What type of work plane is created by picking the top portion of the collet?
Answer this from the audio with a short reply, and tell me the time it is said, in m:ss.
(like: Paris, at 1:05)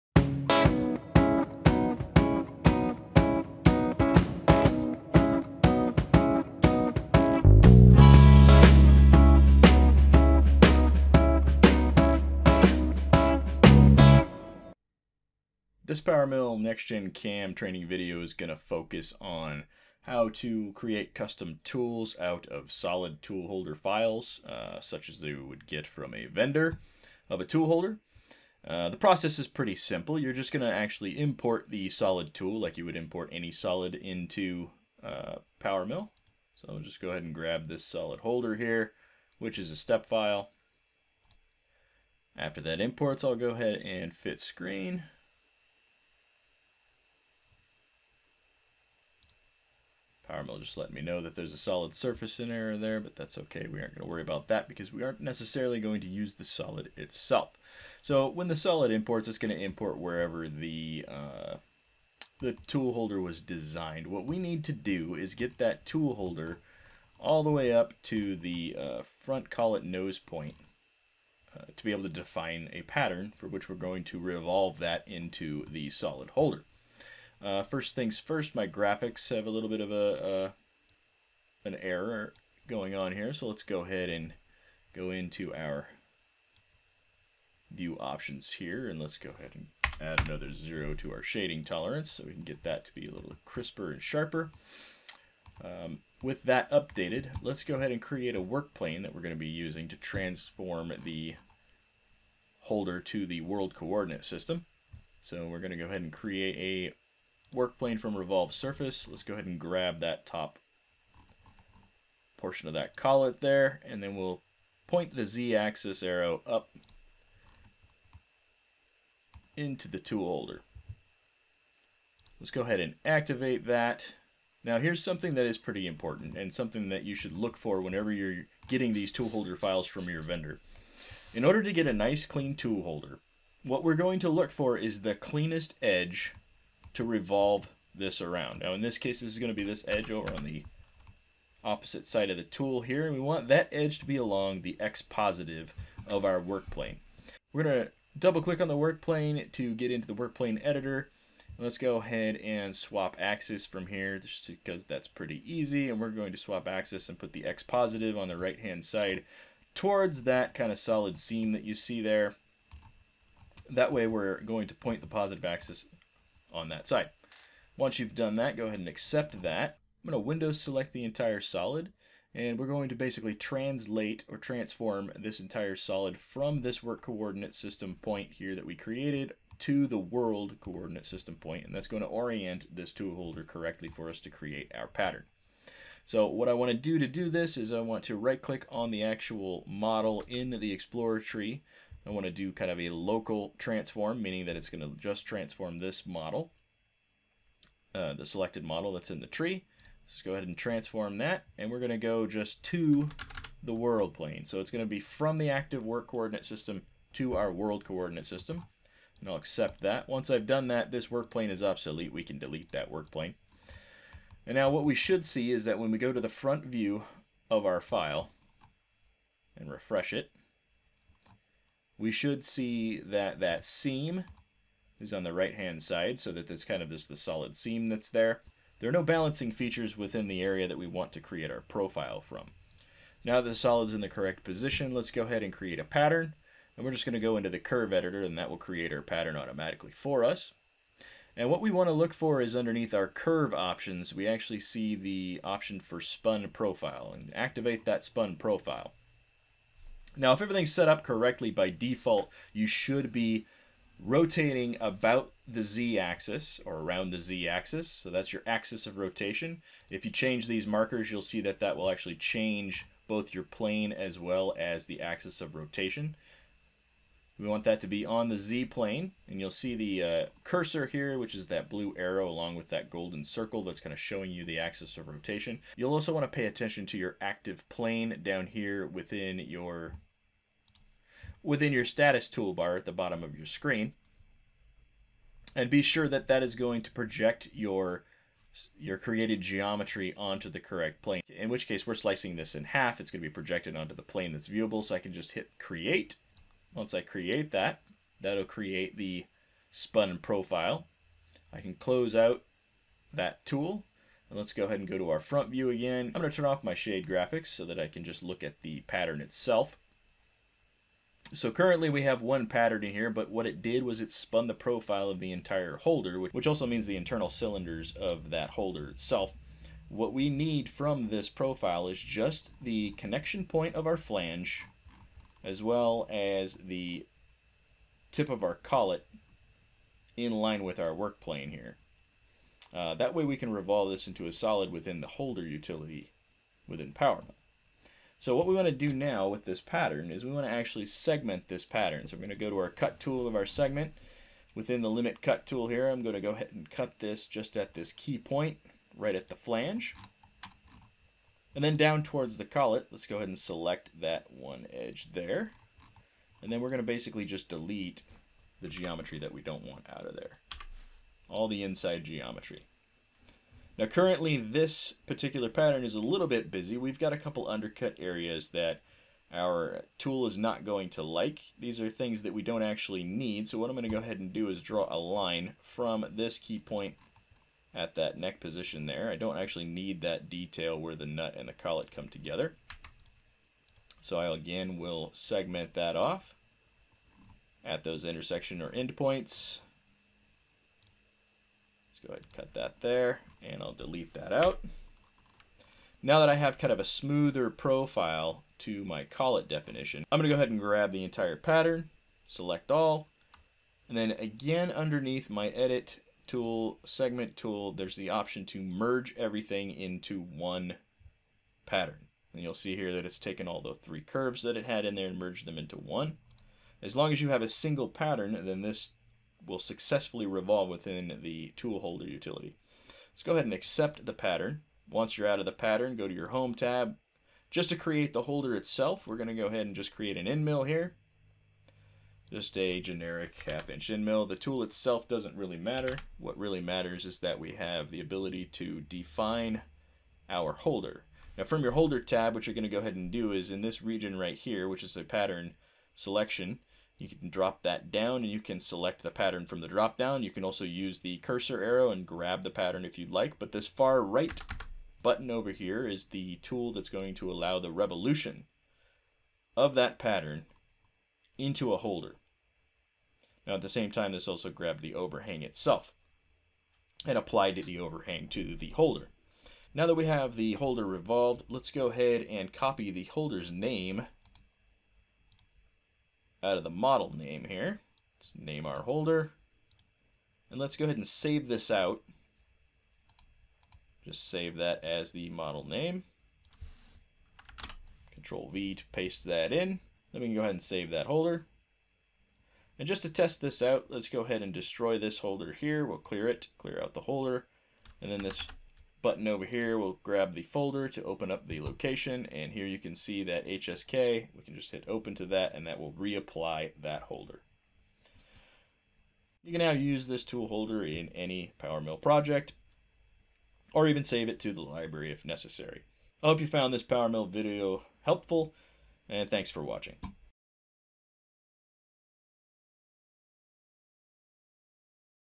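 Work plane from revolved surface, at 1:47.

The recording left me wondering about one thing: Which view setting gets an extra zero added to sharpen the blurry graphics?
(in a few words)
Shading tolerance.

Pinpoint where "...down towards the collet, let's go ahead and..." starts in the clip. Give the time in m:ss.
5:51.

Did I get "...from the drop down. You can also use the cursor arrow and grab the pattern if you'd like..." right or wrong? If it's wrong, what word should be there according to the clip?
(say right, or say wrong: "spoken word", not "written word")
right.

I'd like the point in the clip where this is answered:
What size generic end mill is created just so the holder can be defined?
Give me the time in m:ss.
7:13.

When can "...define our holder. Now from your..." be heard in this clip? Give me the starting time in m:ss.
7:18.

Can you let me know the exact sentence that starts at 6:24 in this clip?
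So I again will segment that off at those intersection or endpoints.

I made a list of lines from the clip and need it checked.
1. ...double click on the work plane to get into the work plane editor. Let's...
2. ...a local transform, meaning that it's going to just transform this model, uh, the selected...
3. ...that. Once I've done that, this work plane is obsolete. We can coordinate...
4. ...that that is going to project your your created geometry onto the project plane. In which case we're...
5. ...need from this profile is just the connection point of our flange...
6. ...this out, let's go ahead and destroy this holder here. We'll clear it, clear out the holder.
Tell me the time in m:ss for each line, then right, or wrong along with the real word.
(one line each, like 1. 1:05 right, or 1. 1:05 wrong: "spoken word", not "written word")
1. 2:28 right
2. 3:12 right
3. 3:29 wrong: "delete", not "coordinate"
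4. 4:46 wrong: "correct", not "project"
5. 5:20 right
6. 8:13 right.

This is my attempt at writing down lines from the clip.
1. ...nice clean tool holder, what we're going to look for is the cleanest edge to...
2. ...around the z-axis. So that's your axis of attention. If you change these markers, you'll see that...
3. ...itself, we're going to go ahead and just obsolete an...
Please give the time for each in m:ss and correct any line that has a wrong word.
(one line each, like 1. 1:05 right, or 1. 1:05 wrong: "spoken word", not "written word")
1. 2:11 right
2. 4:16 wrong: "rotation", not "attention"
3. 7:08 wrong: "create", not "obsolete".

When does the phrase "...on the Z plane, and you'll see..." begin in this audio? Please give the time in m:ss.
4:28.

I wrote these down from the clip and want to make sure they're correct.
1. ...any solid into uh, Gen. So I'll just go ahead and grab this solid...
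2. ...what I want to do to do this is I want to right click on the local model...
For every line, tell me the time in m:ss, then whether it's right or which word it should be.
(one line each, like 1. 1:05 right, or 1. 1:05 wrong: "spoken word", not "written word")
1. 0:33 wrong: "PowerMill", not "Gen"
2. 3:06 wrong: "actual", not "local".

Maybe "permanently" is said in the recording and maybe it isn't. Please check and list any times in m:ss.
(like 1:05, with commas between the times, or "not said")
not said.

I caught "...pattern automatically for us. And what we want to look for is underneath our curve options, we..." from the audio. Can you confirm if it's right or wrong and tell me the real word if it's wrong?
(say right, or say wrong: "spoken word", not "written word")
right.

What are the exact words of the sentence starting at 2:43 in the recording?
That way we're going to point the positive axis on that side.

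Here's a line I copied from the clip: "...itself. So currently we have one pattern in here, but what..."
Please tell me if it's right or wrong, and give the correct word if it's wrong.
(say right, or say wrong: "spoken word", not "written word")
right.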